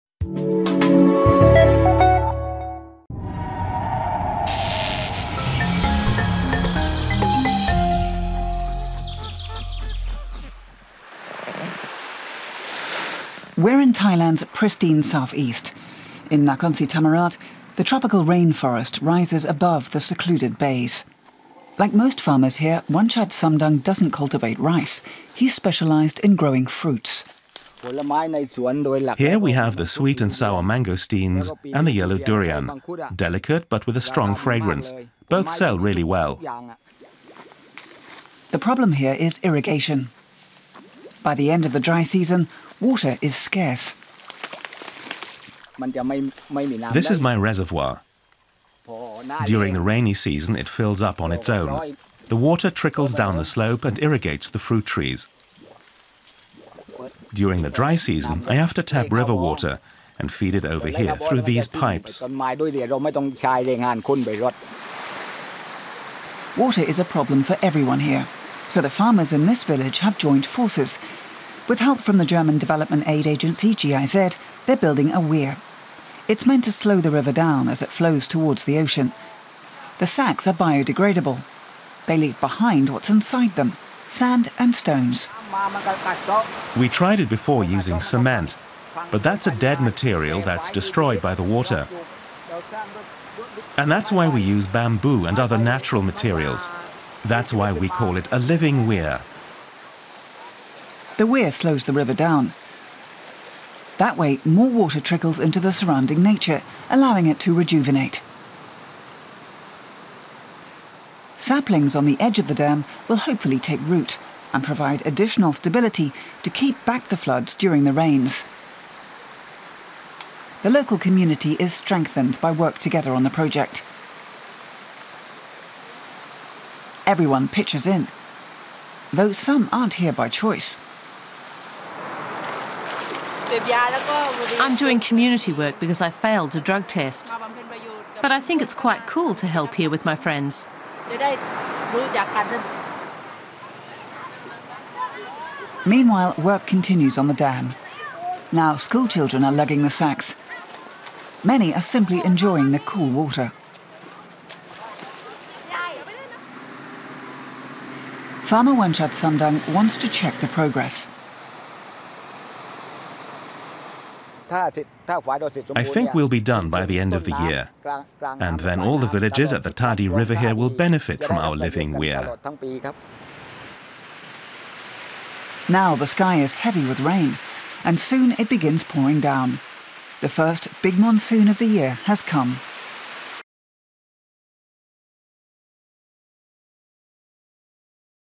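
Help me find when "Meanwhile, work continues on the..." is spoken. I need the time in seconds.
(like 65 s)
145 s.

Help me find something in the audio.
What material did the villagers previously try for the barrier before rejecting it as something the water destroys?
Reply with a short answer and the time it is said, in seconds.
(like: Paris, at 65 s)
cement, at 88 s.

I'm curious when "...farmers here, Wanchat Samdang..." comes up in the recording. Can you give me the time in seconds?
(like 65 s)
22 s.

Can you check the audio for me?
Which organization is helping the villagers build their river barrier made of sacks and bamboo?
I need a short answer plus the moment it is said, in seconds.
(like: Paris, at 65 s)
GIZ, at 73 s.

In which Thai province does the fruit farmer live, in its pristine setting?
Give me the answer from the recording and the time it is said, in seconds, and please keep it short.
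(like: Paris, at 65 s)
Nakhon Si Thammarat, at 16 s.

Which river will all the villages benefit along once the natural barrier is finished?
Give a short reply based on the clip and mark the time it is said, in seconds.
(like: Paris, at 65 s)
Tadi River, at 169 s.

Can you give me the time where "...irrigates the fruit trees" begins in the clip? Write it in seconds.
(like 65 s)
54 s.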